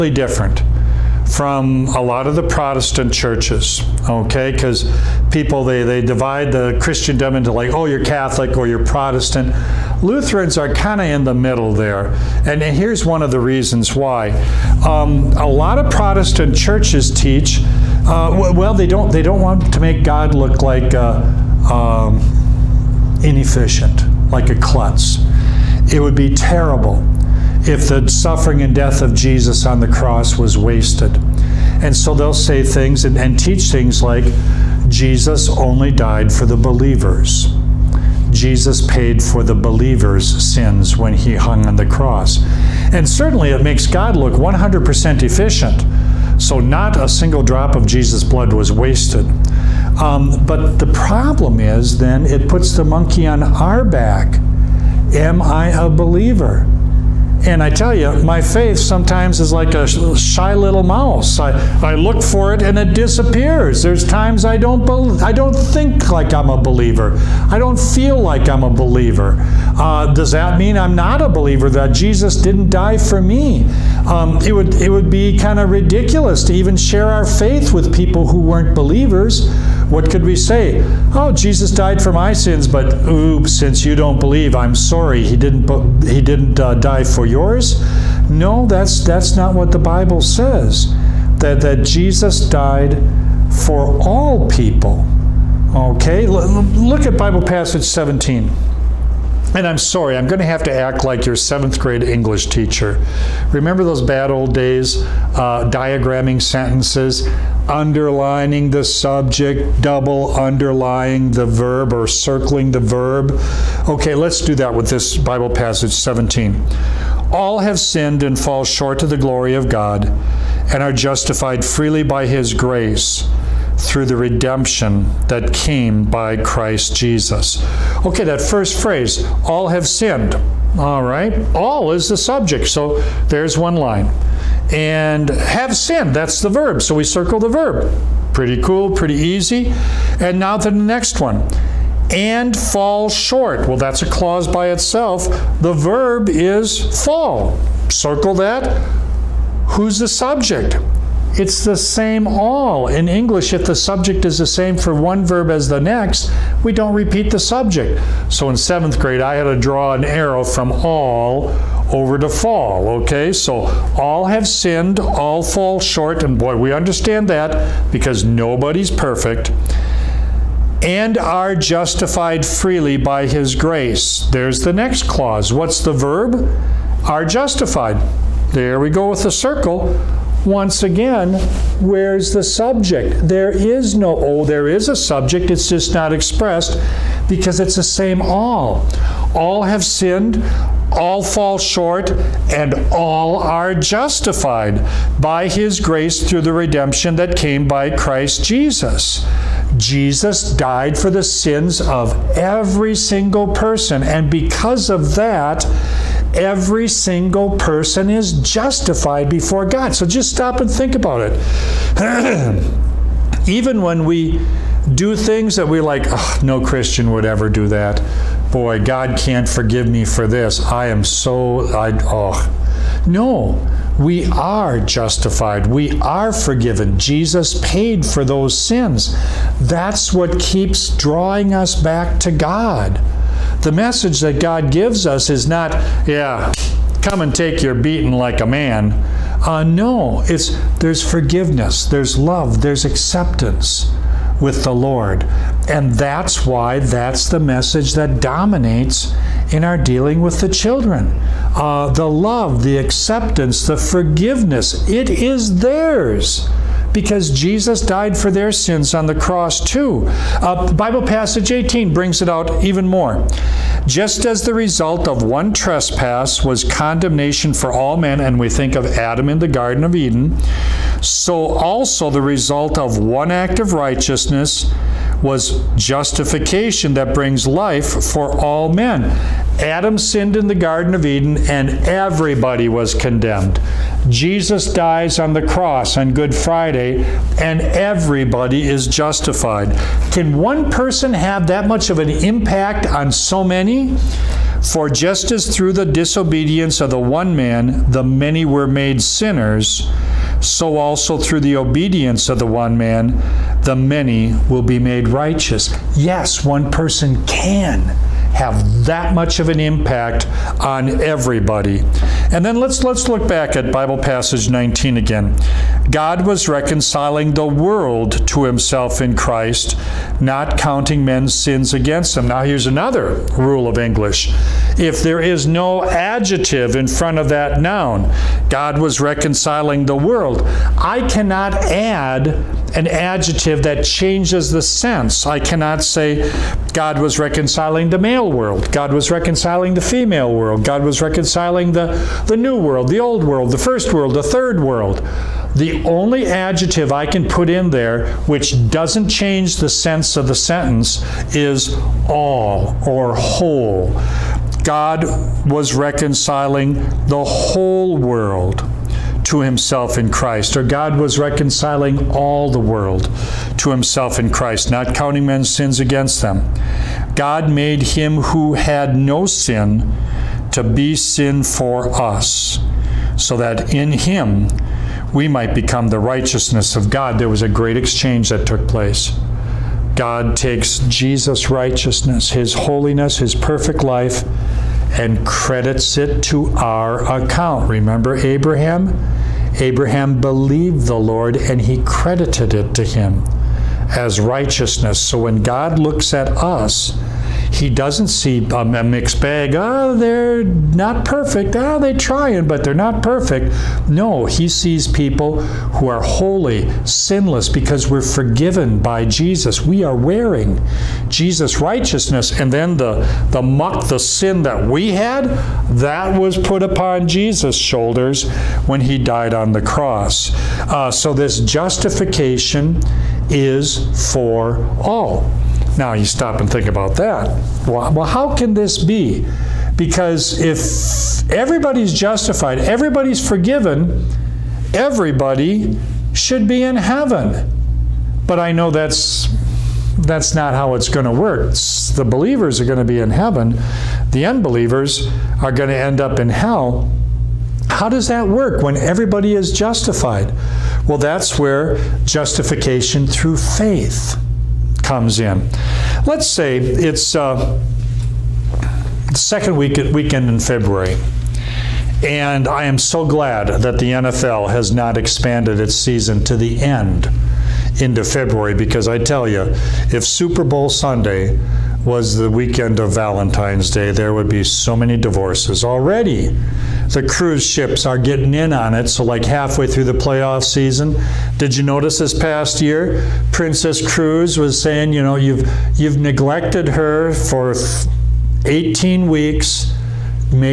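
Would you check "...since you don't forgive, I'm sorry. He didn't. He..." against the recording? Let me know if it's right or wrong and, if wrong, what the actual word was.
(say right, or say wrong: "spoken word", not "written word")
wrong: "believe", not "forgive".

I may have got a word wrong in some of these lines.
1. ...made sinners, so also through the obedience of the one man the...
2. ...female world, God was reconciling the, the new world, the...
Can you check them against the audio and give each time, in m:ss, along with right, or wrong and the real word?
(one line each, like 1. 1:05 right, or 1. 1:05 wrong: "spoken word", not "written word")
1. 4:58 right
2. 5:39 right.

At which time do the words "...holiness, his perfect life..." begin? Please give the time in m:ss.
6:22.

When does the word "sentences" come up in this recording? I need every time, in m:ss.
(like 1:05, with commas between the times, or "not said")
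1:46, 5:50.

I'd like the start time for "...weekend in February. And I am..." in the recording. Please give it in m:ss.
7:39.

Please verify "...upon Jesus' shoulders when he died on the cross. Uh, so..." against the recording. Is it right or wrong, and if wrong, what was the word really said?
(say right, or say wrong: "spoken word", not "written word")
right.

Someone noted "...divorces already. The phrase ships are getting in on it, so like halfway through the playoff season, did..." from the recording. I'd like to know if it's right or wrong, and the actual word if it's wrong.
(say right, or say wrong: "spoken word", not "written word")
wrong: "cruise", not "phrase".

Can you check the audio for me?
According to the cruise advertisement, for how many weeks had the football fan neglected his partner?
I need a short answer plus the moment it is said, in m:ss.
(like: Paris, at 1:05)
18, at 8:08.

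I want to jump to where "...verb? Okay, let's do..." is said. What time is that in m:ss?
1:52.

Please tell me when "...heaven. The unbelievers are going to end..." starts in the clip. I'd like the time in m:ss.
7:23.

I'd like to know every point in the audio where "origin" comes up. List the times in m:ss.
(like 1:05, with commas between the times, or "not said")
not said.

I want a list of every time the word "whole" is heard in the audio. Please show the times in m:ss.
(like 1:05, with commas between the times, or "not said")
5:53, 5:57.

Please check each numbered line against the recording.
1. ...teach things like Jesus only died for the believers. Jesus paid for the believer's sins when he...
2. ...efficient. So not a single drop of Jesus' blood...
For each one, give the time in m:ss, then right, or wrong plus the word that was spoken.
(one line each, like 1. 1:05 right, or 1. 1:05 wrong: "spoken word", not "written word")
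1. 0:33 right
2. 0:45 right.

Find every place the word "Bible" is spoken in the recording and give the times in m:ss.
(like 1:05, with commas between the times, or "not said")
1:29, 1:37, 1:55, 4:20, 5:13.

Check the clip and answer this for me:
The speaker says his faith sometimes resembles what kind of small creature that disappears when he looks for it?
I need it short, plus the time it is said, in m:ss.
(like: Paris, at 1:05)
shy little mouse, at 0:59.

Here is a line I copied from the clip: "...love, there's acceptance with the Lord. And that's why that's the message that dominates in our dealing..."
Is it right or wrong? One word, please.
right.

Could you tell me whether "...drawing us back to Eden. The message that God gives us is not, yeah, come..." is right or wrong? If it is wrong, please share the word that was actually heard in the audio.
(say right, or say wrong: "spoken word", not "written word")
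wrong: "God", not "Eden".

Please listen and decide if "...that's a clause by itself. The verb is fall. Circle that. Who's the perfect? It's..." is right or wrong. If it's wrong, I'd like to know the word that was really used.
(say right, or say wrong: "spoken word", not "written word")
wrong: "subject", not "perfect".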